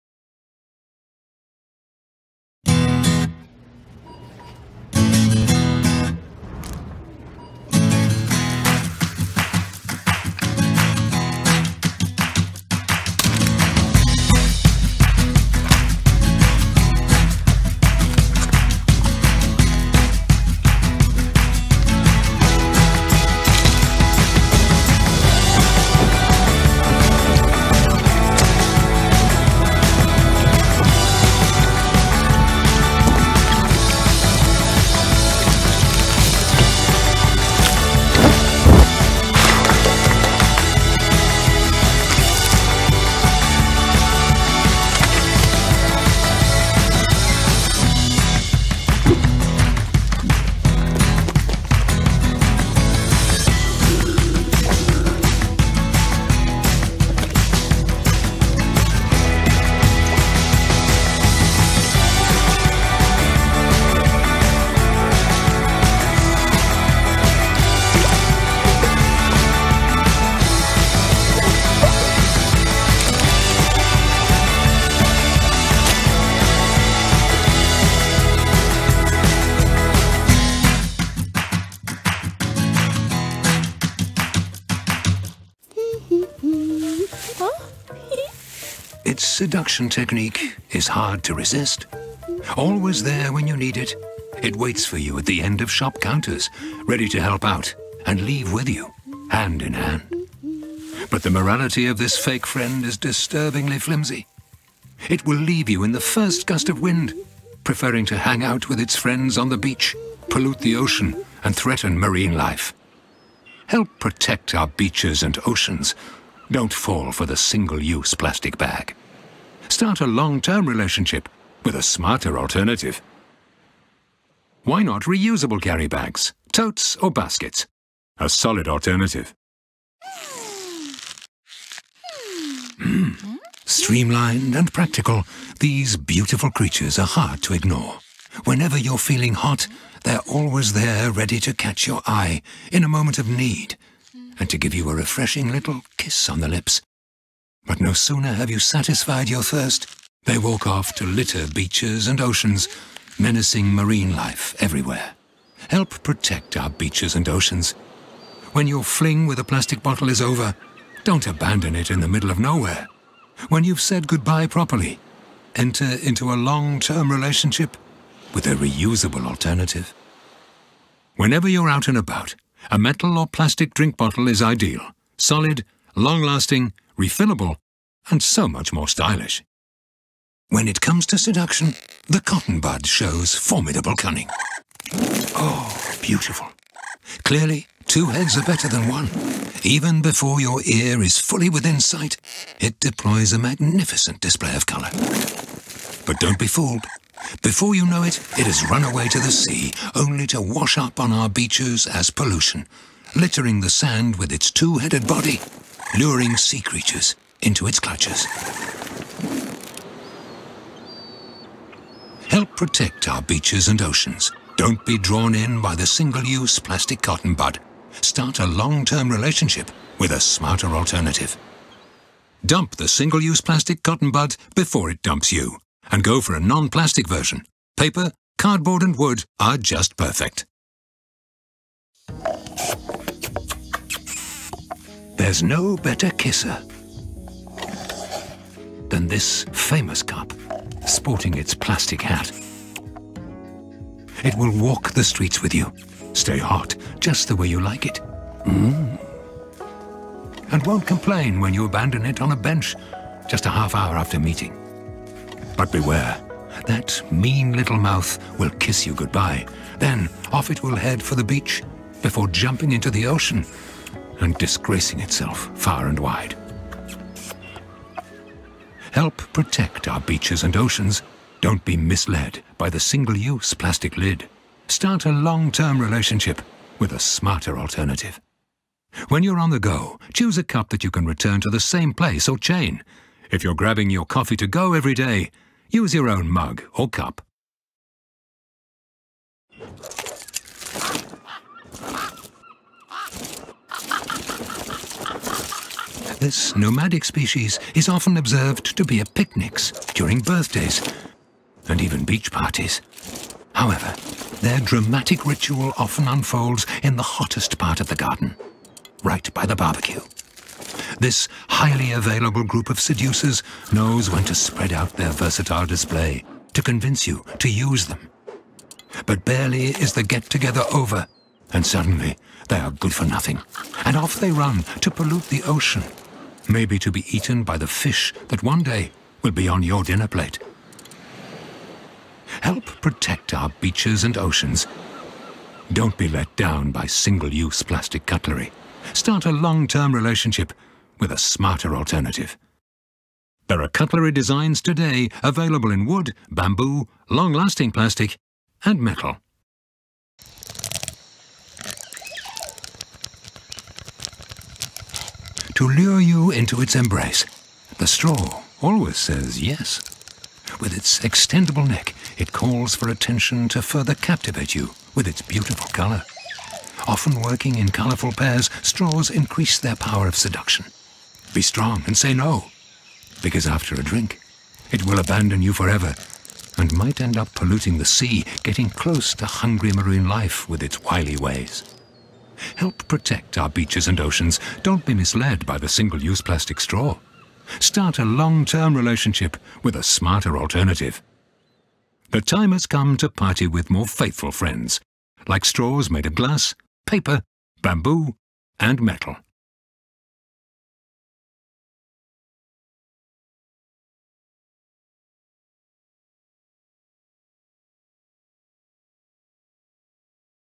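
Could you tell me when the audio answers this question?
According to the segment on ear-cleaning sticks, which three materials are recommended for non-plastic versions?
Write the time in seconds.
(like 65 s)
227 s.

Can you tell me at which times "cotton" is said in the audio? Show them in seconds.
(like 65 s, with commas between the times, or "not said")
182 s, 217 s, 223 s.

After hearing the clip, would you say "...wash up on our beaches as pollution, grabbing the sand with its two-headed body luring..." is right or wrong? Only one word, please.
wrong.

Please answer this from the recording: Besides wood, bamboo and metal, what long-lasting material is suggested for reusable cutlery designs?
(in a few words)
Long-lasting plastic.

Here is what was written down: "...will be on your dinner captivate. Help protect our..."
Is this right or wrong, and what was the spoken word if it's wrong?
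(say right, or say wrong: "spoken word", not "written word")
wrong: "plate", not "captivate".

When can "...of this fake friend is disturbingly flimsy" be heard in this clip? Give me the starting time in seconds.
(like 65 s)
101 s.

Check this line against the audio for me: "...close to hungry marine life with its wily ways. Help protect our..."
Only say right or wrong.
right.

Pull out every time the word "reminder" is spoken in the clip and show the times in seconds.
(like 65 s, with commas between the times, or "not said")
not said.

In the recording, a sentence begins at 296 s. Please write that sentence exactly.
This nomadic species is often observed to be at picnics, during birthdays, and even beach parties.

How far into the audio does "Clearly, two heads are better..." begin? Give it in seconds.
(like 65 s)
187 s.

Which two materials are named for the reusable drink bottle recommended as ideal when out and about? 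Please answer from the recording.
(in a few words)
Metal or plastic.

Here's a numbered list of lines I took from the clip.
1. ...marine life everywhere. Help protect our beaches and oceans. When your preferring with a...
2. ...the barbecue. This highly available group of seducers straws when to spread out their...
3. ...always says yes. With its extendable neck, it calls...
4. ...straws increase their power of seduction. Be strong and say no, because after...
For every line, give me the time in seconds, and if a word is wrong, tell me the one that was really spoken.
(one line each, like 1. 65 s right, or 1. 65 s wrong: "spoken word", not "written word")
1. 153 s wrong: "fling", not "preferring"
2. 309 s wrong: "knows", not "straws"
3. 358 s right
4. 368 s right.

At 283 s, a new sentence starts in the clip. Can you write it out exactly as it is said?
If you're grabbing your coffee to go every day, use your own mug or cup.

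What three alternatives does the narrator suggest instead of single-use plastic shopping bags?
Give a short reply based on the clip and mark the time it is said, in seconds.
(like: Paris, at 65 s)
Reusable carry bags, totes or baskets, at 125 s.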